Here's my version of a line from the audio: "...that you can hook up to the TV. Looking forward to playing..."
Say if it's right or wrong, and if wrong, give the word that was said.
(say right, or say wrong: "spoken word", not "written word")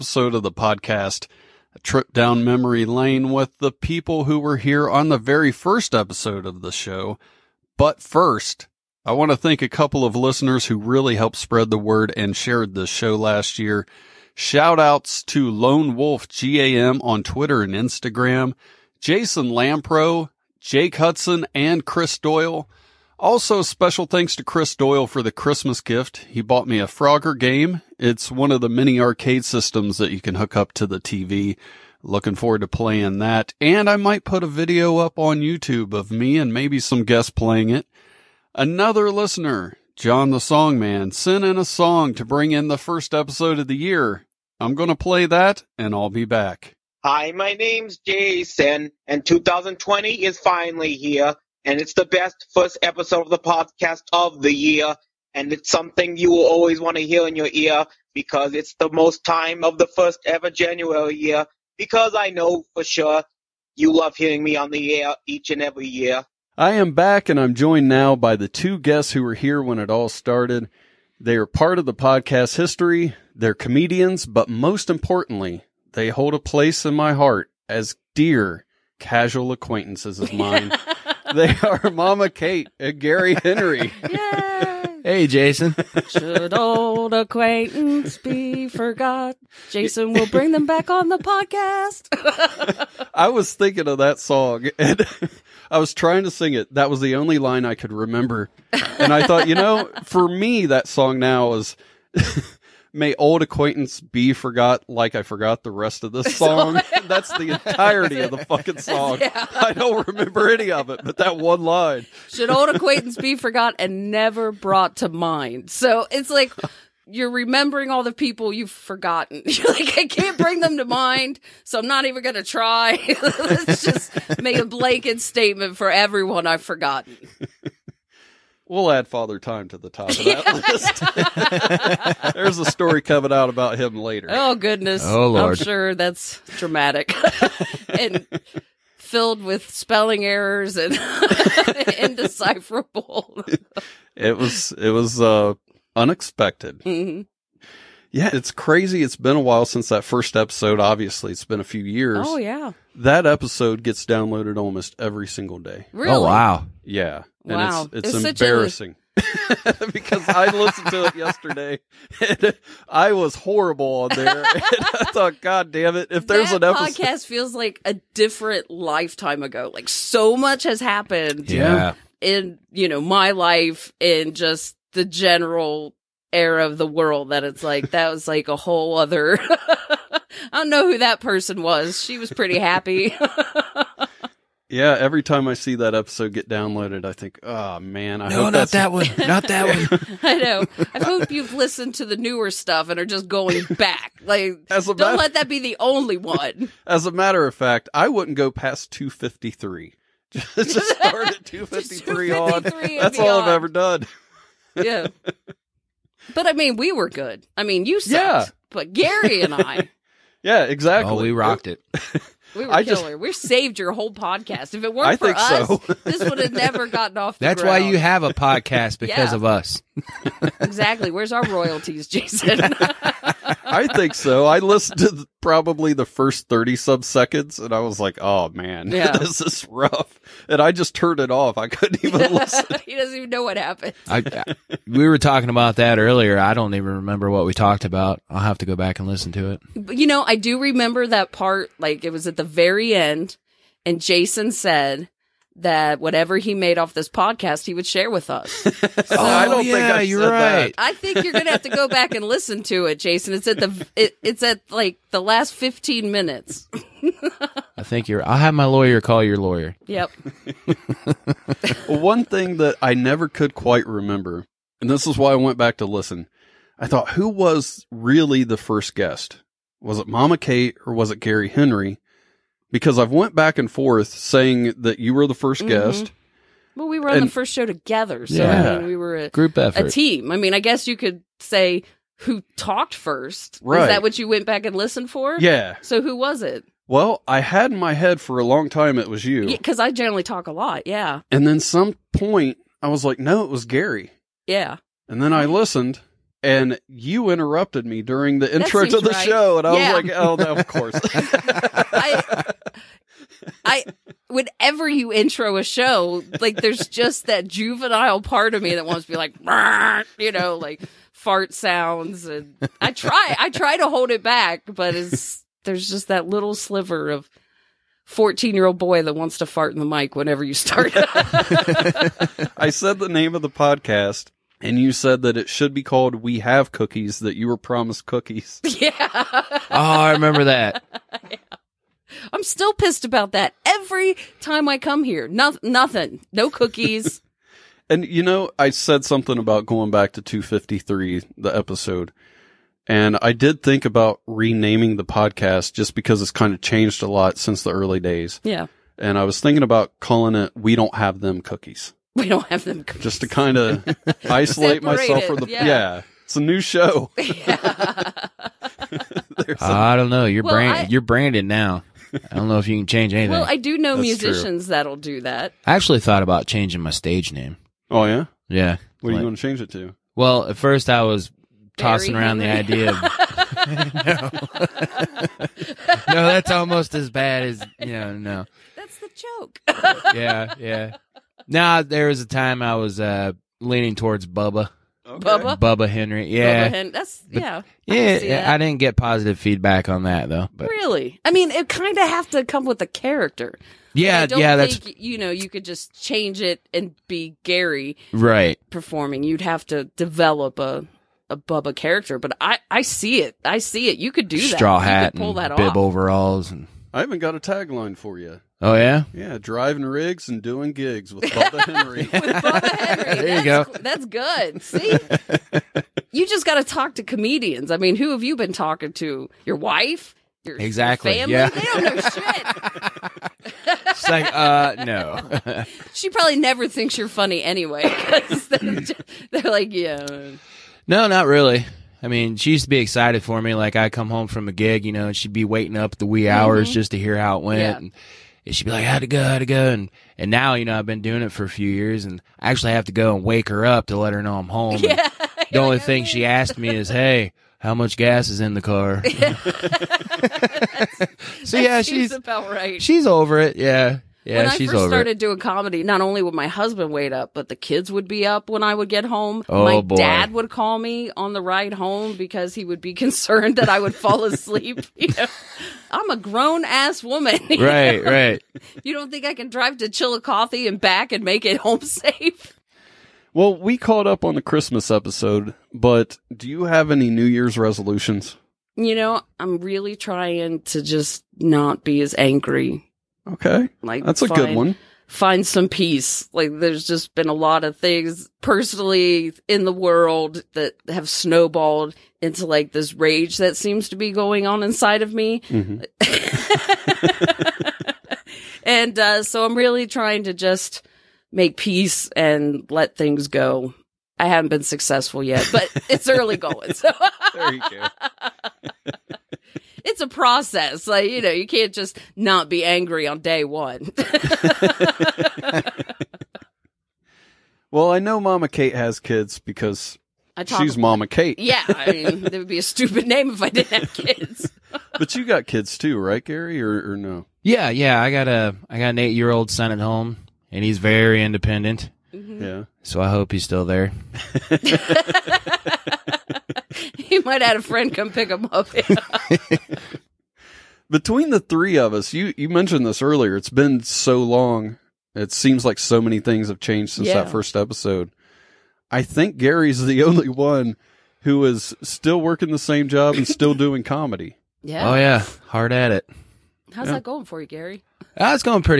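right.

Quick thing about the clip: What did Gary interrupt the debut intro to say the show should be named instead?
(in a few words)
We Have Cookies.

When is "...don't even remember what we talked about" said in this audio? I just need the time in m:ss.
3:56.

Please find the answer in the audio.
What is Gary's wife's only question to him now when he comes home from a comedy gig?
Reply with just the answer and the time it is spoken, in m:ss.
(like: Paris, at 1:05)
How much gas, at 7:27.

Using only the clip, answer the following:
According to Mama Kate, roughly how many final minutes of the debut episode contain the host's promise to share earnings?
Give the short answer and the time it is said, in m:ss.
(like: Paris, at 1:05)
15 minutes, at 4:15.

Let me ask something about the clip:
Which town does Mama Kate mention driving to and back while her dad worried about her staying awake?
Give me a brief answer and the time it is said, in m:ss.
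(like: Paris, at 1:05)
Chillicothe, at 7:49.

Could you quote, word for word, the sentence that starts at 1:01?
Because I know for sure you love hearing me on the air each and every year.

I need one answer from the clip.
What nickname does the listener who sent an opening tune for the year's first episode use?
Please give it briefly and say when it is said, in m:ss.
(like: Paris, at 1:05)
John the Songman, at 0:39.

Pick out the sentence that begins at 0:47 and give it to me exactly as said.
Hi, my name's Jason, and 2020 is finally here and it's the best first episode of the podcast of the year.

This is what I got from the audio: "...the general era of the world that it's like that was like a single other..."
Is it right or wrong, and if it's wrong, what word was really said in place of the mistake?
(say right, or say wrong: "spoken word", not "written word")
wrong: "whole", not "single".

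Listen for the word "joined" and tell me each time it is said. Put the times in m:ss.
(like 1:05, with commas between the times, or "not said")
1:07.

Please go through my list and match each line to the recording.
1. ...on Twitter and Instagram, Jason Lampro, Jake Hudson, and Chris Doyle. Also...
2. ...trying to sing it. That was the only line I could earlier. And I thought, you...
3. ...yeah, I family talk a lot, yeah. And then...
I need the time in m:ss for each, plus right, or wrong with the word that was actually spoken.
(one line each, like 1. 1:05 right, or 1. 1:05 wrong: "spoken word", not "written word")
1. 0:17 right
2. 1:35 wrong: "remember", not "earlier"
3. 4:49 wrong: "generally", not "family".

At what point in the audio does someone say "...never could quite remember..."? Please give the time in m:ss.
4:22.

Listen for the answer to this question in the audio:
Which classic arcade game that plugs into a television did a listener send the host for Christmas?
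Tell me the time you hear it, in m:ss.
0:26.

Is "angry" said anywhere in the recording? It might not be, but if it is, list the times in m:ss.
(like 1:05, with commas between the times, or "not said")
8:02, 8:32.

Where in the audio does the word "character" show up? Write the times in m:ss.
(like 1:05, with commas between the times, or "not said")
6:32, 6:41.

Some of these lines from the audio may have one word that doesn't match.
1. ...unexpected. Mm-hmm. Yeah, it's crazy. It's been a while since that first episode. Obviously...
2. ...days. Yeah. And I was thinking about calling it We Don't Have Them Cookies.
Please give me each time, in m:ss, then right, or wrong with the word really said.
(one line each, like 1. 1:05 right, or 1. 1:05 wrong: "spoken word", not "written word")
1. 2:25 right
2. 5:47 right.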